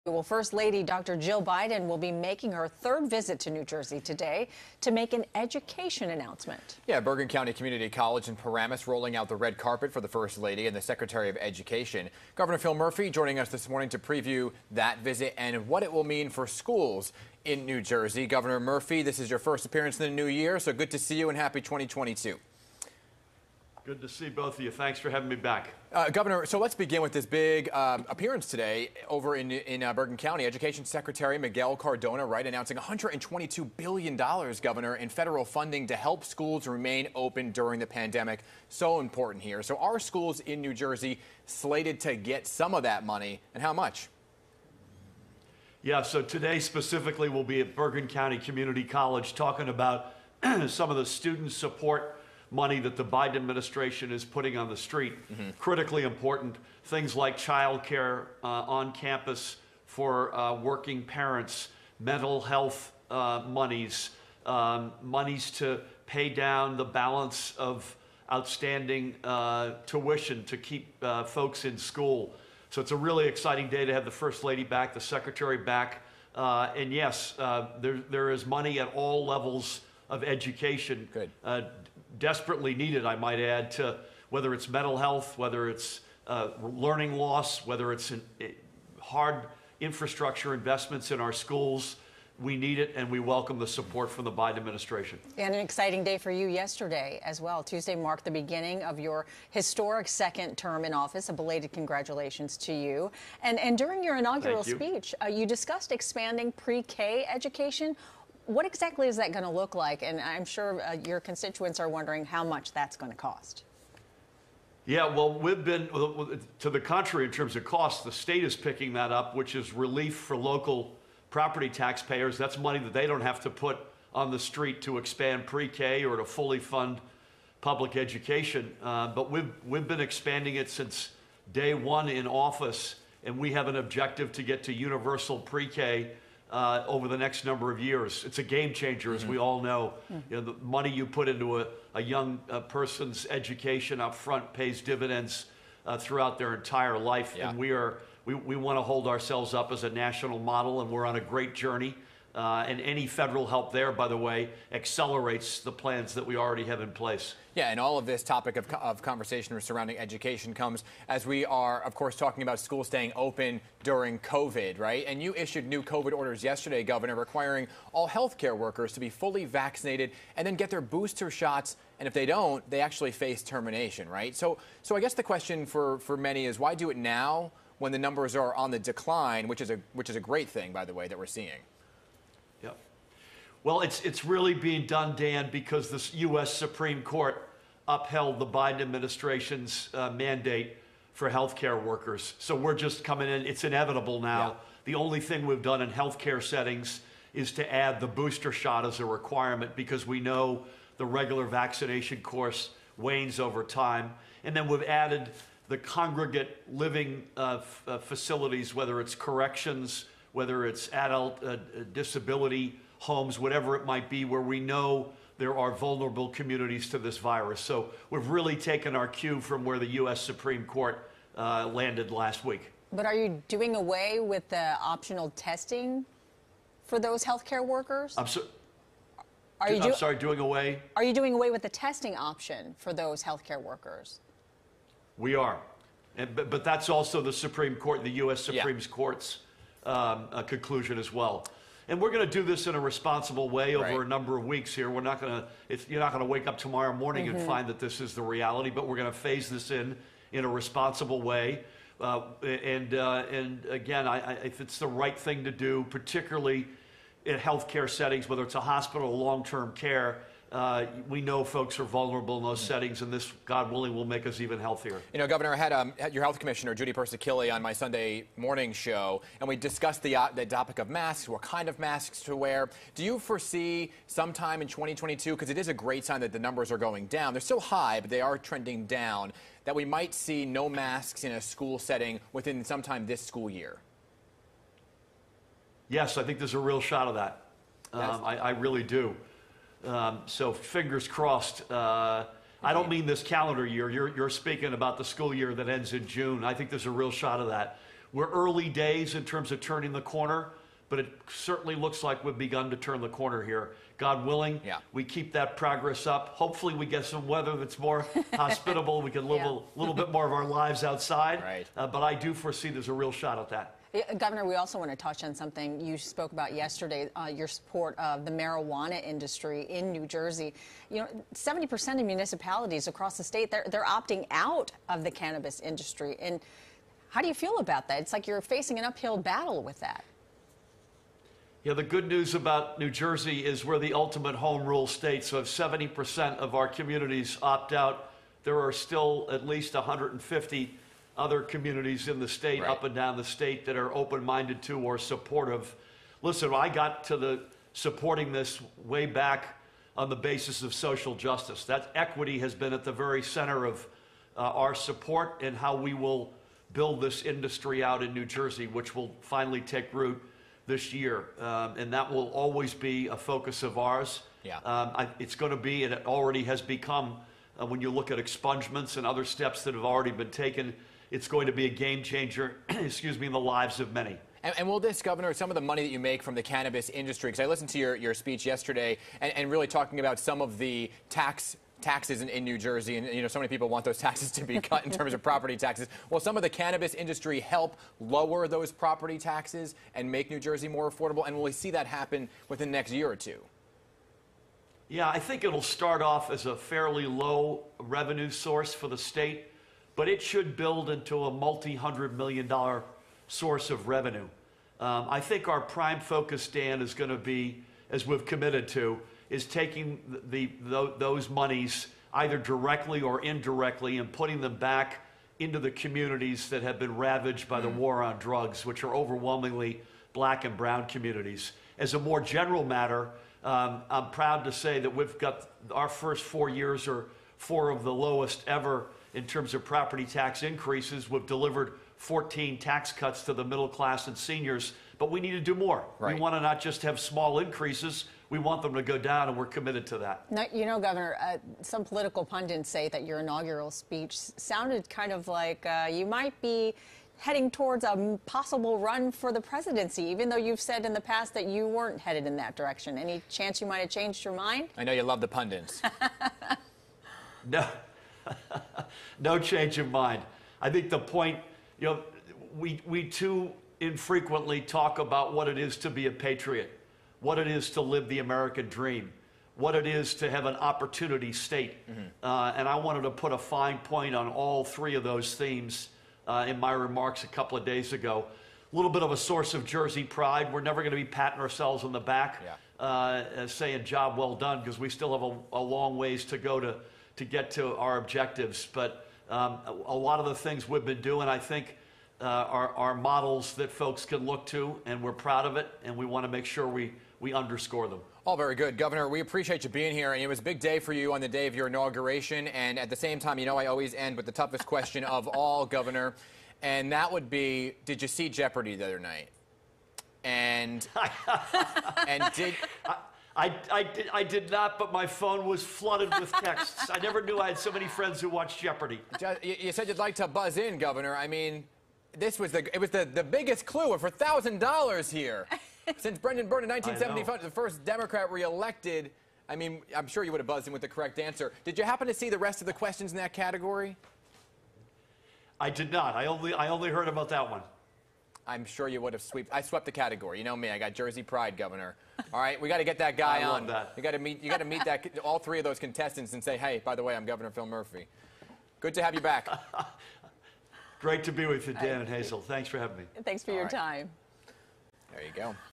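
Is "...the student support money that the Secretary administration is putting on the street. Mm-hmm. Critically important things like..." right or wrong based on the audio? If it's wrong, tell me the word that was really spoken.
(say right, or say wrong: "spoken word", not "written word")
wrong: "Biden", not "Secretary".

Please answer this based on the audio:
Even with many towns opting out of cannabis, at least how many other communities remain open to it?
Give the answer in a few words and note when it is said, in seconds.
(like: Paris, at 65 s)
150, at 339 s.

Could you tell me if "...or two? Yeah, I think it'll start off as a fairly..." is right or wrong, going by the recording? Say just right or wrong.
right.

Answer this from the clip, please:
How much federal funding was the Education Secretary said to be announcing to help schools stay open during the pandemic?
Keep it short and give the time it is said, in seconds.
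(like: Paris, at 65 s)
$122 billion, at 32 s.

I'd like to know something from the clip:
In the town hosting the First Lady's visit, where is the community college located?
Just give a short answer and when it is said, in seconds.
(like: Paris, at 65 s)
Paramus, at 8 s.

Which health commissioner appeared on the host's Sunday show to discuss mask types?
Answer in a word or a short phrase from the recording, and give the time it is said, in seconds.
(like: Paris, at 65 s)
Judy Persichilli, at 266 s.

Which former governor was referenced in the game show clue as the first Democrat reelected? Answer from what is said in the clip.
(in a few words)
Brendan Byrne.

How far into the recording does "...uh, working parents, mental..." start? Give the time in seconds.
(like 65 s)
60 s.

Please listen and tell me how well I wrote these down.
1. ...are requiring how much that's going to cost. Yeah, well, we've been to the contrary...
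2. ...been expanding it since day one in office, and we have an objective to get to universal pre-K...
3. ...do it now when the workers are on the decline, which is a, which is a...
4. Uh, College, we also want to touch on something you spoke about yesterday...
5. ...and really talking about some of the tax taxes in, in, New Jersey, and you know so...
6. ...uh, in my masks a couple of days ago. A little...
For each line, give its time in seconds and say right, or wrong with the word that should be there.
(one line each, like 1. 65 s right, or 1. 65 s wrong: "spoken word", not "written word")
1. 111 s wrong: "wondering", not "requiring"
2. 129 s right
3. 176 s wrong: "numbers", not "workers"
4. 313 s wrong: "Governor", not "College"
5. 379 s right
6. 476 s wrong: "remarks", not "masks".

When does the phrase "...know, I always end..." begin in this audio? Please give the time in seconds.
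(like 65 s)
503 s.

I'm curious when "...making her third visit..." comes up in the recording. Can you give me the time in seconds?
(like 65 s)
2 s.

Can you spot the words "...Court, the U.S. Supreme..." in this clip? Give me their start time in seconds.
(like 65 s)
237 s.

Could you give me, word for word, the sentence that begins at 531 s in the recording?
Did you happen to see the rest of the questions in that category?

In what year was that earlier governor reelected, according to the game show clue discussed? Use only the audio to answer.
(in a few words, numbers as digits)
1975.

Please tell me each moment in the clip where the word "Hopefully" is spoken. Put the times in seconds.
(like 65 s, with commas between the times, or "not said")
306 s.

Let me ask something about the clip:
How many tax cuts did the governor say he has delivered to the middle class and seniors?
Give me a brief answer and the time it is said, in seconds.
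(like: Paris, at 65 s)
14, at 432 s.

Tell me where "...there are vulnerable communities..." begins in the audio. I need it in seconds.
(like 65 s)
215 s.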